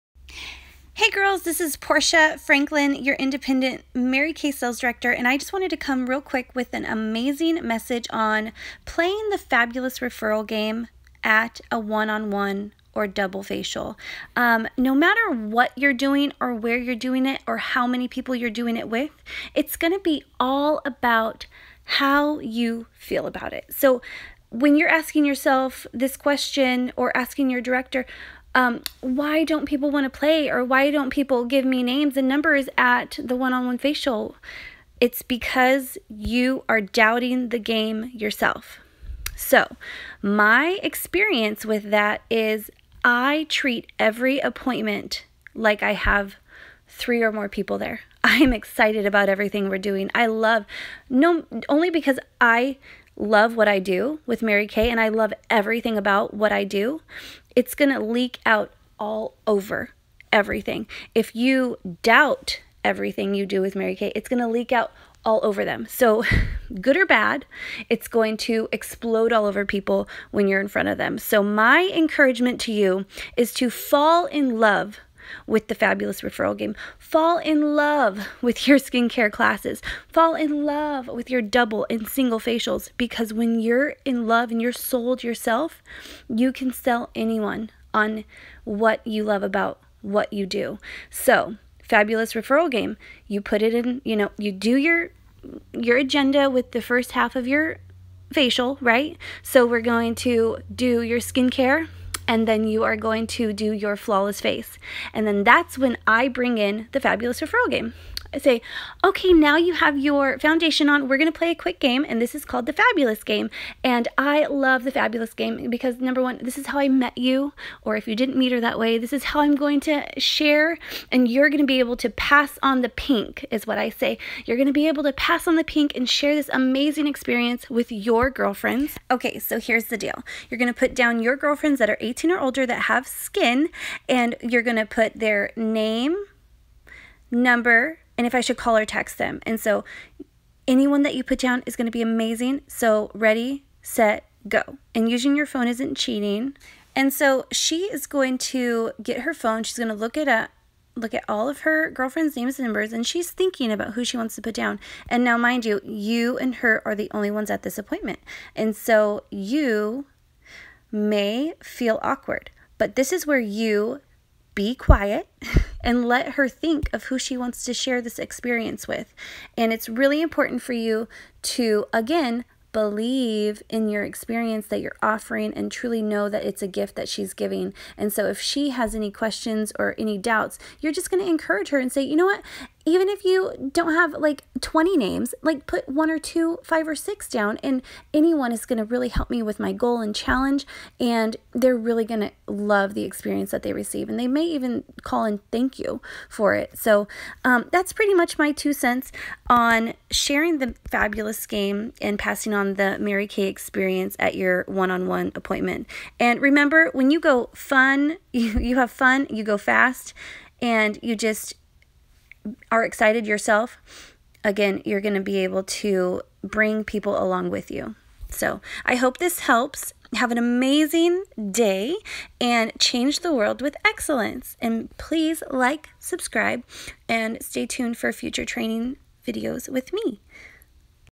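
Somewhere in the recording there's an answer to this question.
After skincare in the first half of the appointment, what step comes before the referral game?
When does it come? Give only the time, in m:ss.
1:43.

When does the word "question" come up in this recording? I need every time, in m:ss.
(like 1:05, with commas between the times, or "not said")
0:26, 2:59.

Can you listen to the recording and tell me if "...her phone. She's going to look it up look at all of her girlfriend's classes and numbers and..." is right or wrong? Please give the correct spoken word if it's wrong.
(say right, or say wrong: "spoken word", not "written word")
wrong: "names", not "classes".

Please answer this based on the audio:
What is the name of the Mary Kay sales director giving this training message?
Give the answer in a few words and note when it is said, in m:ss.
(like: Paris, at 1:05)
Portia Franklin, at 0:01.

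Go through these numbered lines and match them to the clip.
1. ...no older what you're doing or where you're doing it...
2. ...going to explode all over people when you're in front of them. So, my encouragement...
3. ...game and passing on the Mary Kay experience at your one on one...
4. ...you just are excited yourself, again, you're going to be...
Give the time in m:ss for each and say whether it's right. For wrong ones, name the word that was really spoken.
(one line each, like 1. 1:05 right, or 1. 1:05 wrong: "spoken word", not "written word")
1. 0:14 wrong: "matter", not "older"
2. 1:08 right
3. 3:21 right
4. 3:31 right.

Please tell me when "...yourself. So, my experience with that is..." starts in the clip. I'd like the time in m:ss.
0:38.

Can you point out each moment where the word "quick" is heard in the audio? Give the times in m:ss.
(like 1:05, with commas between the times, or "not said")
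0:06, 1:51.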